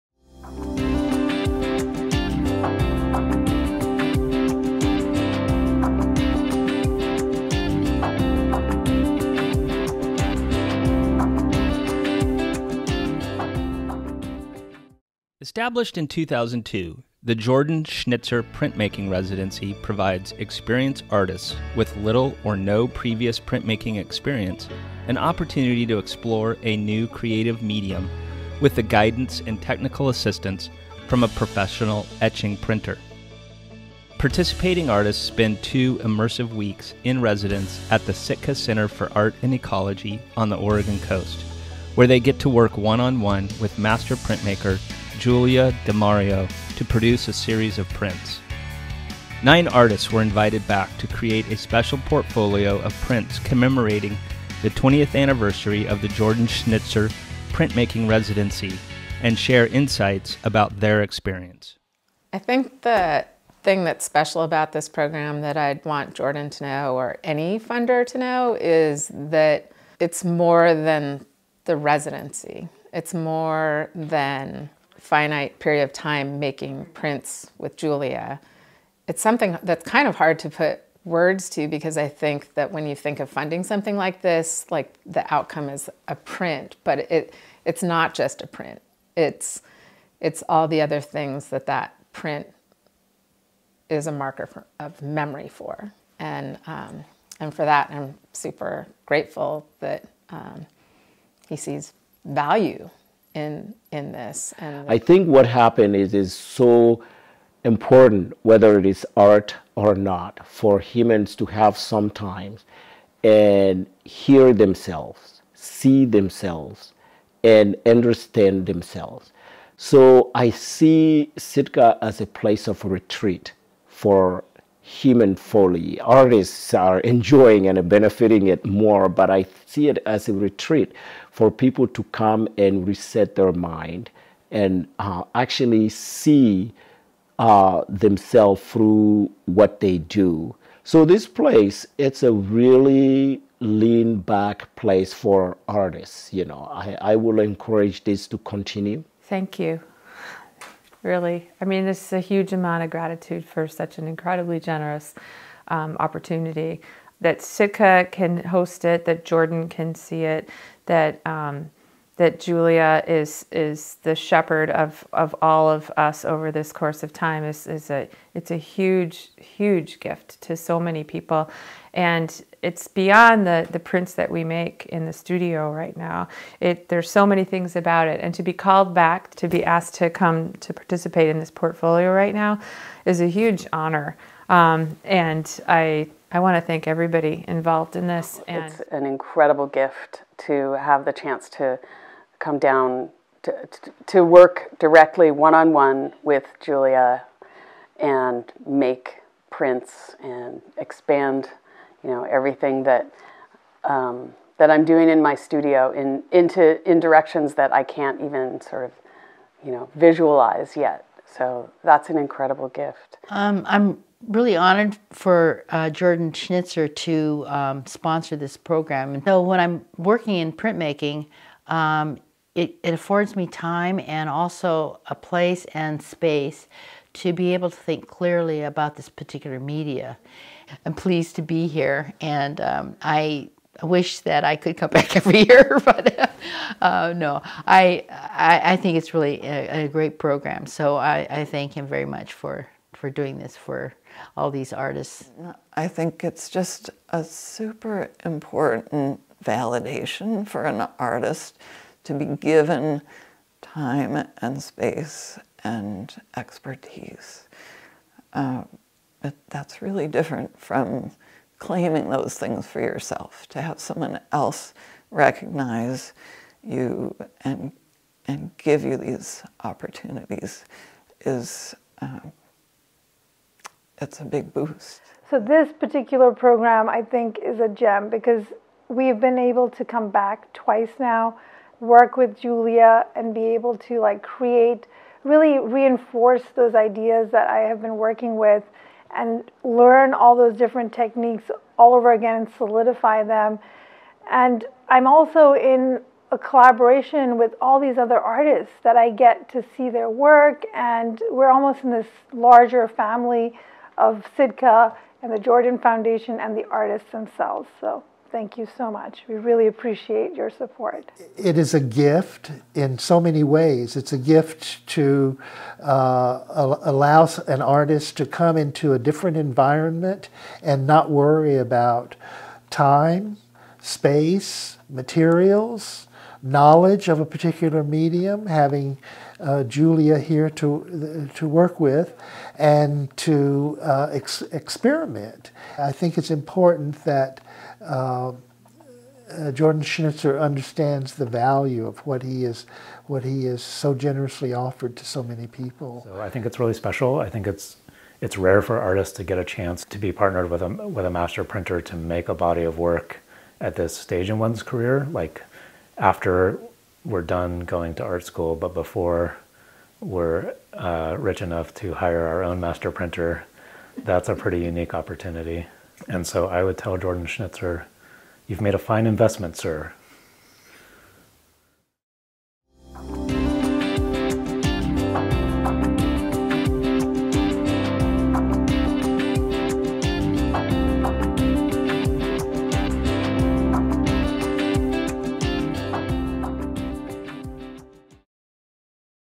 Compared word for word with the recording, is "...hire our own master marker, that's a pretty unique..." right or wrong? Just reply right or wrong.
wrong.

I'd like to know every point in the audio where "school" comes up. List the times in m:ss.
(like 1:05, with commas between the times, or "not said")
5:58.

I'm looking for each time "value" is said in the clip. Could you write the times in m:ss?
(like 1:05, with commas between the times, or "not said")
1:42, 5:41.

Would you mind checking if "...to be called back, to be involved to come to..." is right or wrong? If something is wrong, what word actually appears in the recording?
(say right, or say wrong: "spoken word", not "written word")
wrong: "asked", not "involved".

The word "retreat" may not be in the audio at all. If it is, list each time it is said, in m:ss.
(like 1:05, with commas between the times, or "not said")
2:02, 2:10.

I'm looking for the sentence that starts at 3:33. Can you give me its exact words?
Um, I'm really honored for uh, Jordan Schnitzer to um, sponsor this program.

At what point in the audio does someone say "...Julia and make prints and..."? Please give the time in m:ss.
3:16.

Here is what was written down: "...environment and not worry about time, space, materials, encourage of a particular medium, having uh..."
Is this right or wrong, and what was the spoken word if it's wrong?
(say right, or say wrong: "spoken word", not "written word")
wrong: "knowledge", not "encourage".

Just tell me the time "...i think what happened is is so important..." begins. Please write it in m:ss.
1:44.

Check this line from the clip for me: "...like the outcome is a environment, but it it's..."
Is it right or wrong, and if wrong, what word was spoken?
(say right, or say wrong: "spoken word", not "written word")
wrong: "print", not "environment".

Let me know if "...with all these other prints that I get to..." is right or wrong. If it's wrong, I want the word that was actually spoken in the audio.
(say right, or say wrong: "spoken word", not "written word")
wrong: "artists", not "prints".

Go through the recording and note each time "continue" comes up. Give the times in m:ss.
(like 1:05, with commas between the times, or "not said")
2:28.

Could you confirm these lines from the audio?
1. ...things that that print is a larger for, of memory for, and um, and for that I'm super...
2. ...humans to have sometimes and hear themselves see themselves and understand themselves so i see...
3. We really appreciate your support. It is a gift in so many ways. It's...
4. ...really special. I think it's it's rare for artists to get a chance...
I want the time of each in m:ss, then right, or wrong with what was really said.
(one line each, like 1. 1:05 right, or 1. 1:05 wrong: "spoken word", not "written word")
1. 1:31 wrong: "marker", not "larger"
2. 1:50 right
3. 5:09 right
4. 5:46 right.